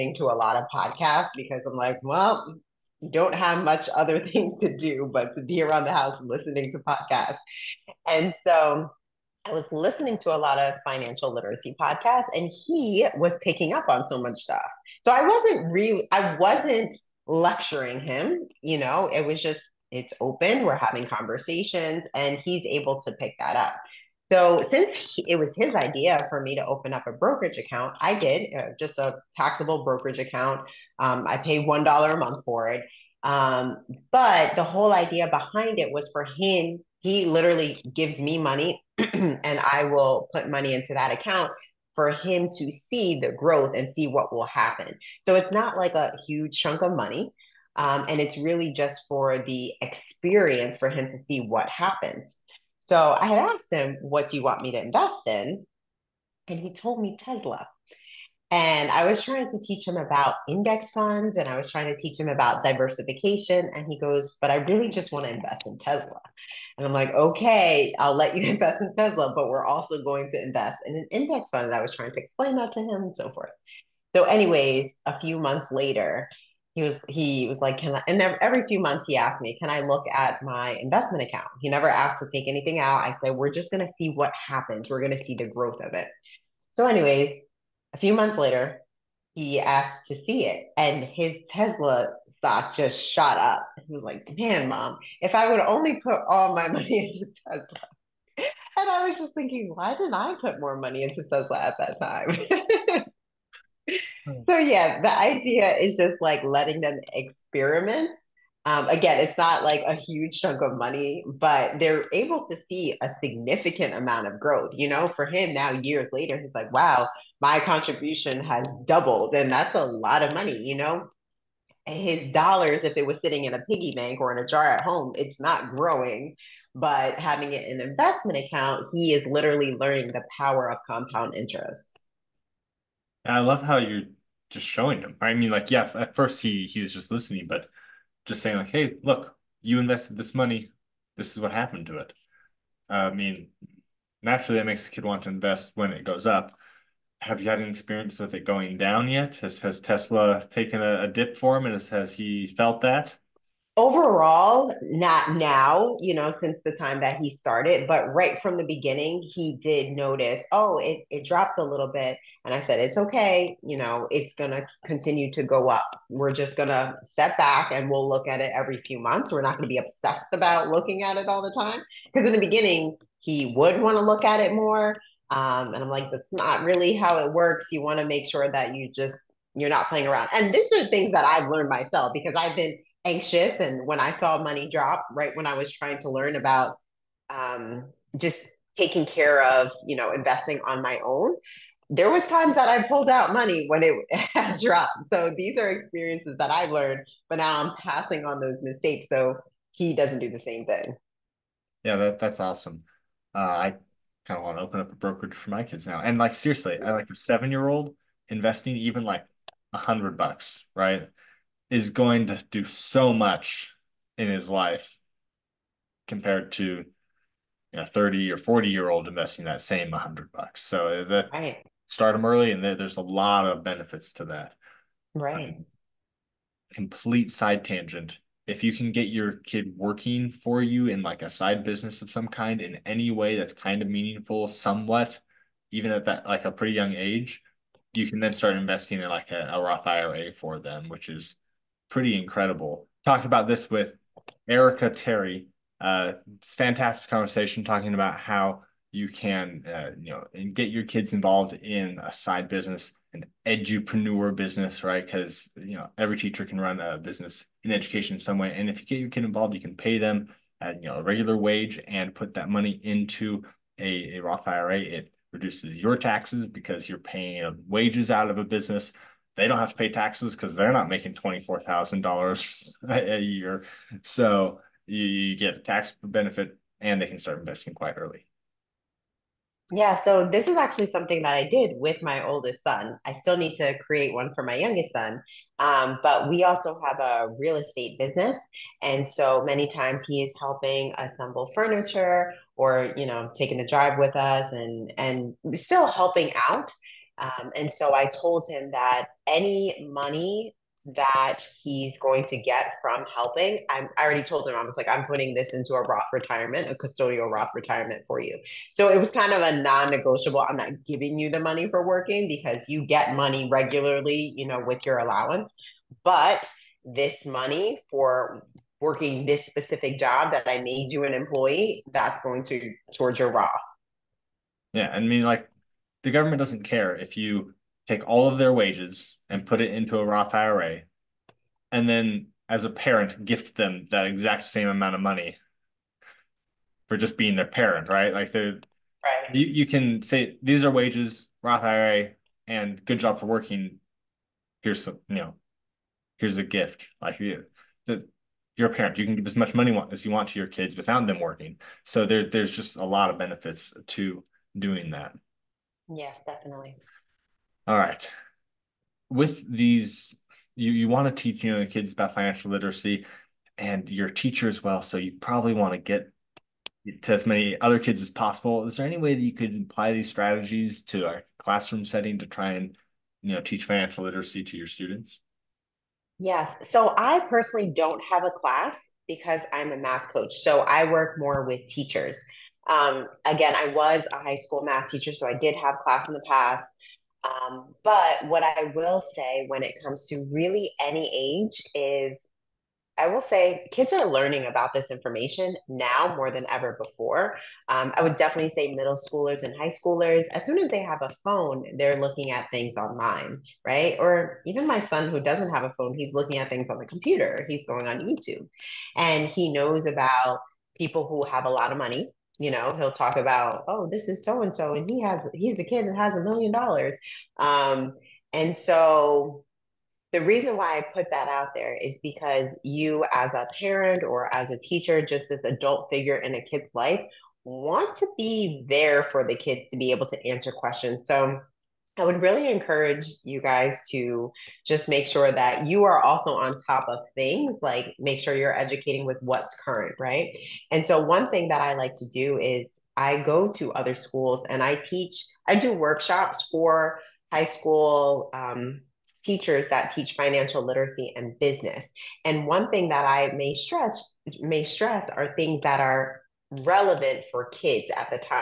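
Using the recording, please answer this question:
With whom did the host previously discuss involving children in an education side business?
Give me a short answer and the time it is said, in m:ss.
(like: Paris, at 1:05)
Erica Terry, at 4:04.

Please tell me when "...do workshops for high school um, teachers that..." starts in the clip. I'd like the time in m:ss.
7:25.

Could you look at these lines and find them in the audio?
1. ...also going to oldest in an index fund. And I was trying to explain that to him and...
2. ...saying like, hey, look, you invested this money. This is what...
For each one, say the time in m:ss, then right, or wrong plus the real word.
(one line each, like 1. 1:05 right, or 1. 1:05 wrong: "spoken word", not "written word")
1. 1:09 wrong: "invest", not "oldest"
2. 2:18 right.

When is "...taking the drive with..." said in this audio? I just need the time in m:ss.
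4:53.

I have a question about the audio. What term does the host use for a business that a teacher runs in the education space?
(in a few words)
edupreneur business.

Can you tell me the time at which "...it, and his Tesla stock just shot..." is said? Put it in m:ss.
1:30.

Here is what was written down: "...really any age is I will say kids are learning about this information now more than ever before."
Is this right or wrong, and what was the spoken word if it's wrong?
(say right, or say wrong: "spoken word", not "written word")
right.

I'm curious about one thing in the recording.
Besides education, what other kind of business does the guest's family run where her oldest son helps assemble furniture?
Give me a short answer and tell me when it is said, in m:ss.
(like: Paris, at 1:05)
real estate, at 4:47.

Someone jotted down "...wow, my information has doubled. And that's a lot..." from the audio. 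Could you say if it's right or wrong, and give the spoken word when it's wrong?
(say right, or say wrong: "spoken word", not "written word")
wrong: "contribution", not "information".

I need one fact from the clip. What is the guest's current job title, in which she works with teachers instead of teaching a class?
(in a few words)
math coach.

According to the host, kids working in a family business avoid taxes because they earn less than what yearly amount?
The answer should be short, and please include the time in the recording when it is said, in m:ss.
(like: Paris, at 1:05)
$24,000, at 4:31.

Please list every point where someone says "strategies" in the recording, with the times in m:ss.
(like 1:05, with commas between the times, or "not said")
6:10.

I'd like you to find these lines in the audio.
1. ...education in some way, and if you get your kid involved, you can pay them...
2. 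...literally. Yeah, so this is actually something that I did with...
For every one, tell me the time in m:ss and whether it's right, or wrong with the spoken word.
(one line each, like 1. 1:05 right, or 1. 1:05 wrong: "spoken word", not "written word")
1. 4:17 right
2. 4:37 wrong: "early", not "literally".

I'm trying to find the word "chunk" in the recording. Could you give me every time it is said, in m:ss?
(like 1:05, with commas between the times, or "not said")
0:46, 1:50.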